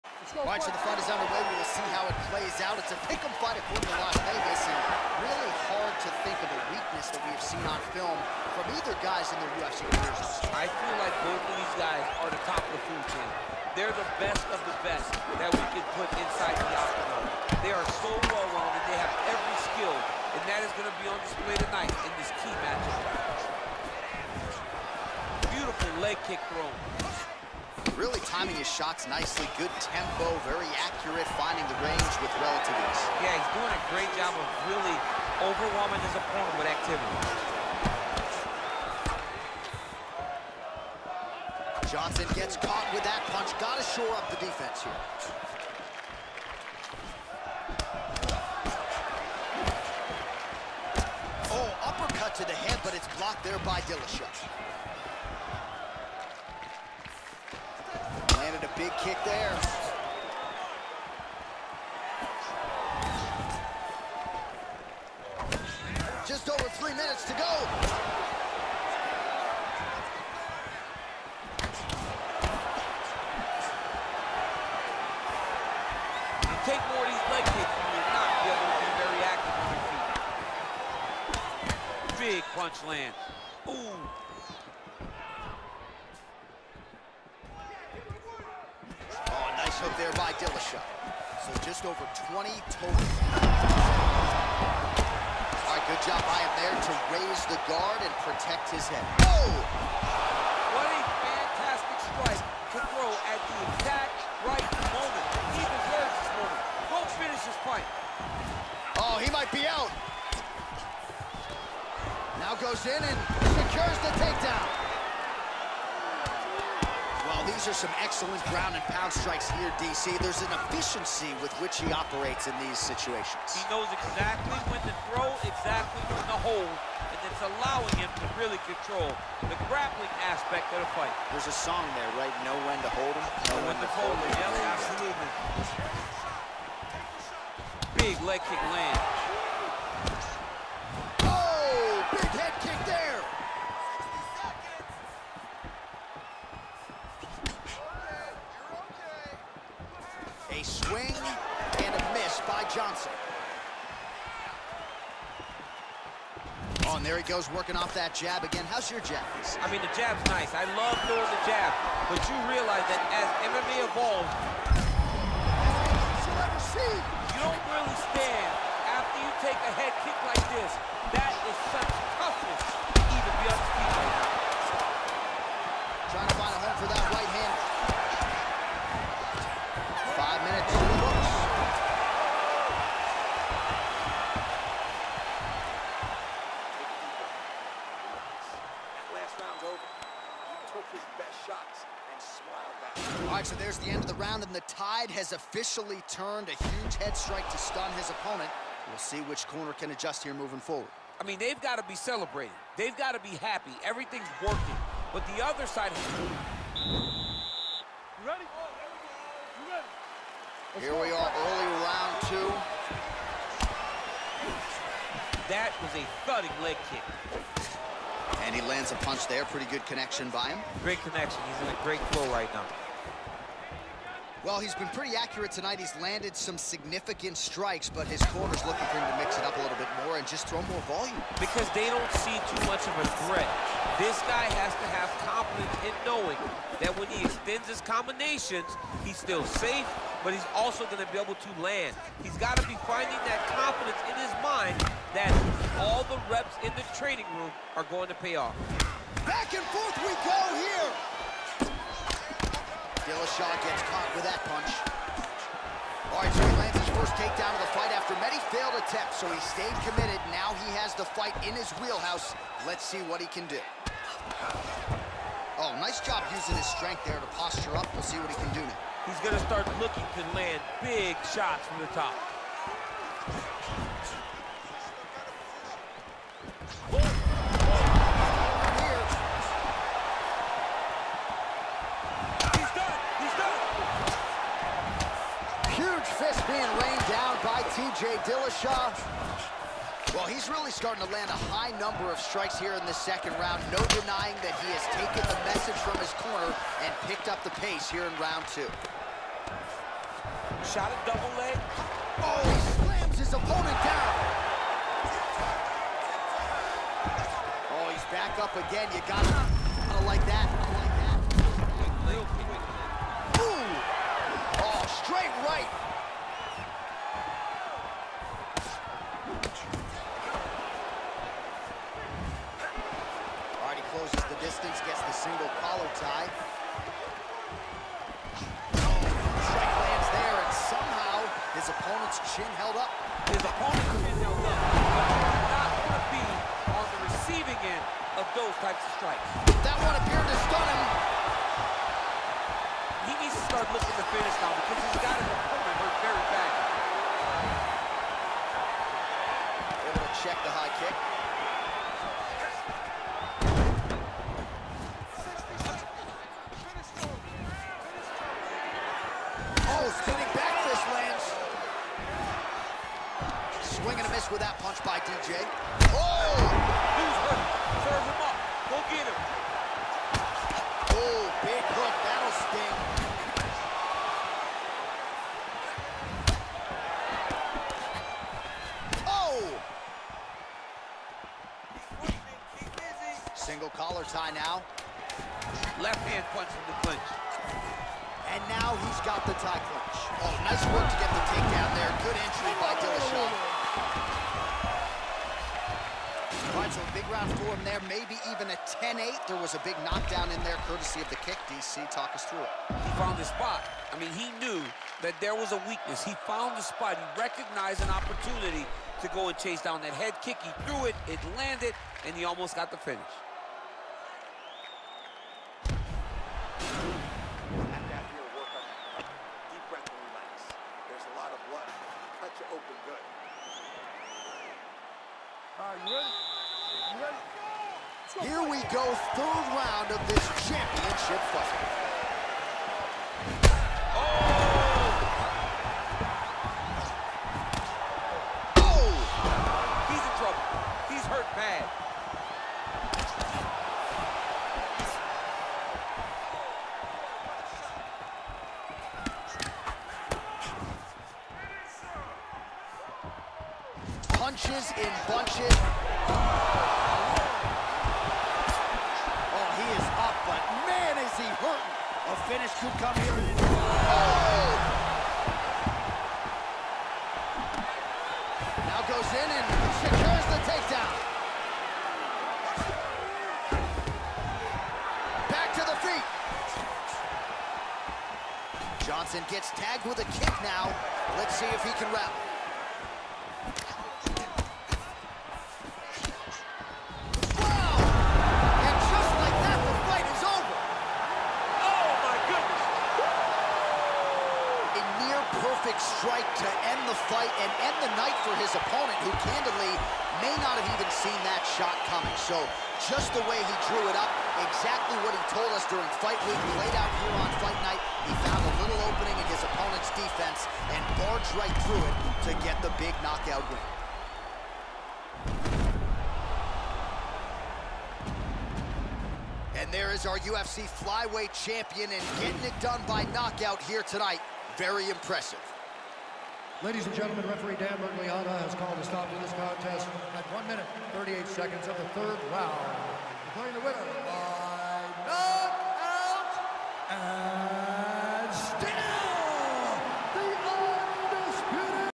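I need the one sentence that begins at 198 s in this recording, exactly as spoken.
We'll see which corner can adjust here moving forward.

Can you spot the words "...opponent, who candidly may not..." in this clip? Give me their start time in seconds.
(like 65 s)
498 s.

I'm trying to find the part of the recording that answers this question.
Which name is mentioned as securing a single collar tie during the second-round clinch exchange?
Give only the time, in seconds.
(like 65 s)
324 s.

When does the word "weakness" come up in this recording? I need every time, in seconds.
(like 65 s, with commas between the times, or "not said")
6 s, 405 s.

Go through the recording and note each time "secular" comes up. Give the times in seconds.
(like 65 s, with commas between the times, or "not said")
not said.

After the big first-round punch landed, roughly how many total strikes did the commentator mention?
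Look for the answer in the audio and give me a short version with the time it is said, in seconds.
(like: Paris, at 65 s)
Just over 20, at 91 s.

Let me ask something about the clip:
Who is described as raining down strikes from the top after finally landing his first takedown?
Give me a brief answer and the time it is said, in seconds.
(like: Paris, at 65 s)
T.J. Dillashaw, at 287 s.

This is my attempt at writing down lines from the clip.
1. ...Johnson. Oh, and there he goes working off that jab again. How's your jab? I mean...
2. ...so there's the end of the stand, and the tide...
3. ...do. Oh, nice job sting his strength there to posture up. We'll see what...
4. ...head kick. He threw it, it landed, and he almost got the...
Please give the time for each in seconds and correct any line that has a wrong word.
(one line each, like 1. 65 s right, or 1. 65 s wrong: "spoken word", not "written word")
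1. 152 s right
2. 193 s wrong: "round", not "stand"
3. 263 s wrong: "using", not "sting"
4. 409 s right.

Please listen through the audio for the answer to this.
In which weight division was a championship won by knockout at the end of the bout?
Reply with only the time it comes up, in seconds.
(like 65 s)
520 s.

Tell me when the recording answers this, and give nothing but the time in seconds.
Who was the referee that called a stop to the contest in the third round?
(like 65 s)
527 s.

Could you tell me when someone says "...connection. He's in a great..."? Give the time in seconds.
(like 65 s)
221 s.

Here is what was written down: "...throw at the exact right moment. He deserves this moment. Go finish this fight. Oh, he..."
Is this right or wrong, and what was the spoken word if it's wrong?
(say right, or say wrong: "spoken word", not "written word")
right.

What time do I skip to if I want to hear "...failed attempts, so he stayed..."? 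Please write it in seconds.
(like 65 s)
258 s.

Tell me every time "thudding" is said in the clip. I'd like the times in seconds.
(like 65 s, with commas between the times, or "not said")
216 s.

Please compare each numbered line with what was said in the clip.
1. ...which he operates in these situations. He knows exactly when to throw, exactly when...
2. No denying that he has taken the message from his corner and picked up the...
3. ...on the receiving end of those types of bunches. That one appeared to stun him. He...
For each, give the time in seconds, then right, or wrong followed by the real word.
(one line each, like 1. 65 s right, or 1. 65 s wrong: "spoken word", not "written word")
1. 121 s right
2. 293 s right
3. 336 s wrong: "strikes", not "bunches".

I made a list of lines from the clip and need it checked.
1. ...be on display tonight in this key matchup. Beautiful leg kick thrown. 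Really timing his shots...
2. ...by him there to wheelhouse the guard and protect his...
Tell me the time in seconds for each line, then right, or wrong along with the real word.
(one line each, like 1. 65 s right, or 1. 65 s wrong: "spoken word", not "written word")
1. 21 s right
2. 96 s wrong: "raise", not "wheelhouse".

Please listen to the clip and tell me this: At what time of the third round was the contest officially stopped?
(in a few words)
1 minute 38 seconds.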